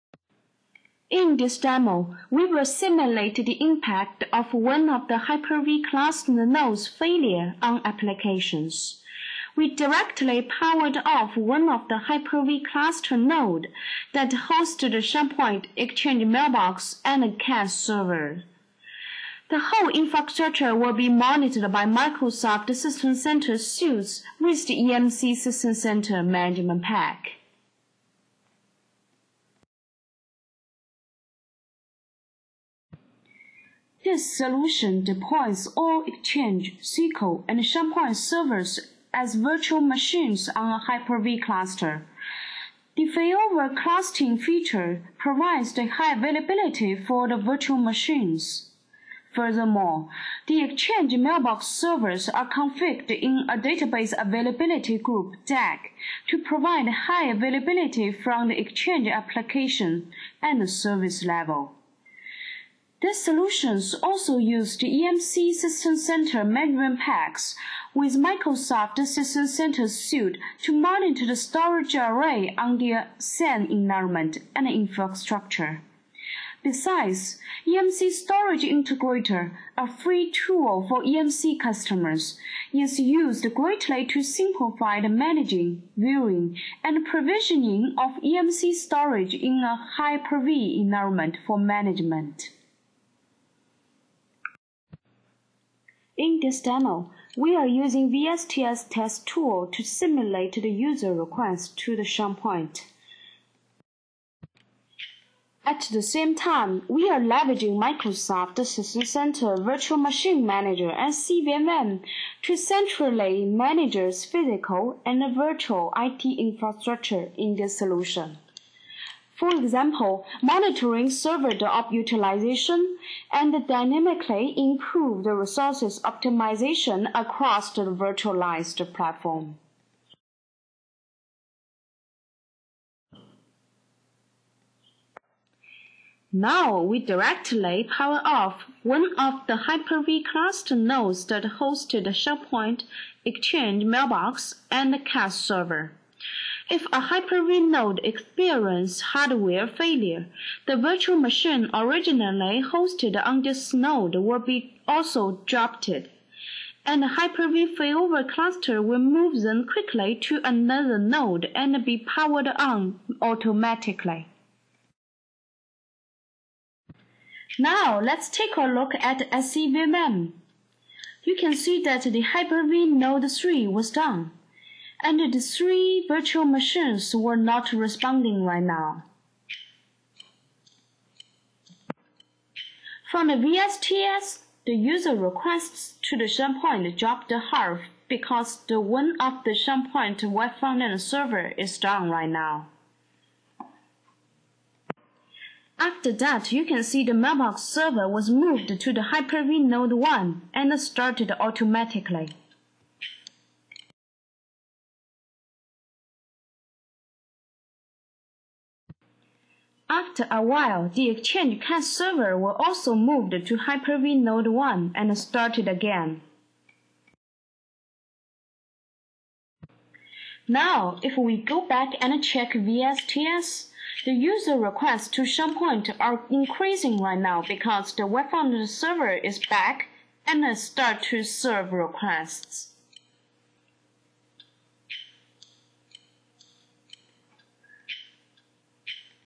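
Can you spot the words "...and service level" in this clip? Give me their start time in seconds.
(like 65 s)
60 s.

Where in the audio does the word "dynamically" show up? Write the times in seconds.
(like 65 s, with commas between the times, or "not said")
123 s.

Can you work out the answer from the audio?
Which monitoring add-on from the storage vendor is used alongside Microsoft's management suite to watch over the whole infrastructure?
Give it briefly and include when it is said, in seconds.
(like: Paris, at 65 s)
EMC System Center Management Pack, at 24 s.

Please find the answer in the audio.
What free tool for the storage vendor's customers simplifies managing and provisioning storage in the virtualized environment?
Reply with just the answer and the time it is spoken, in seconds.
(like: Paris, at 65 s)
EMC Storage Integrator, at 77 s.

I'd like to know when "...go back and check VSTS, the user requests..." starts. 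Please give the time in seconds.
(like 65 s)
221 s.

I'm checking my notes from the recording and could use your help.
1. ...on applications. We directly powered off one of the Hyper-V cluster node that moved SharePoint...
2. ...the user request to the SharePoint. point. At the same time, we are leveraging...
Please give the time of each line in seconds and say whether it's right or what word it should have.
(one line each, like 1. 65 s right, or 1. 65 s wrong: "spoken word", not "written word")
1. 7 s wrong: "hosted", not "moved"
2. 100 s right.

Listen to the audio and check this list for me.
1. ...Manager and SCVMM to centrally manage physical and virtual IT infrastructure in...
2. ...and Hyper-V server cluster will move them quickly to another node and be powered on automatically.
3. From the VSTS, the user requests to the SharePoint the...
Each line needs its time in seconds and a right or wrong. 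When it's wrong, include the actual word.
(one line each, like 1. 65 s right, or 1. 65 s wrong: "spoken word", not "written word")
1. 110 s right
2. 155 s wrong: "failover", not "server"
3. 183 s right.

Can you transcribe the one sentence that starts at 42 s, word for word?
The failover clustering feature provides the high availability for the virtual machines.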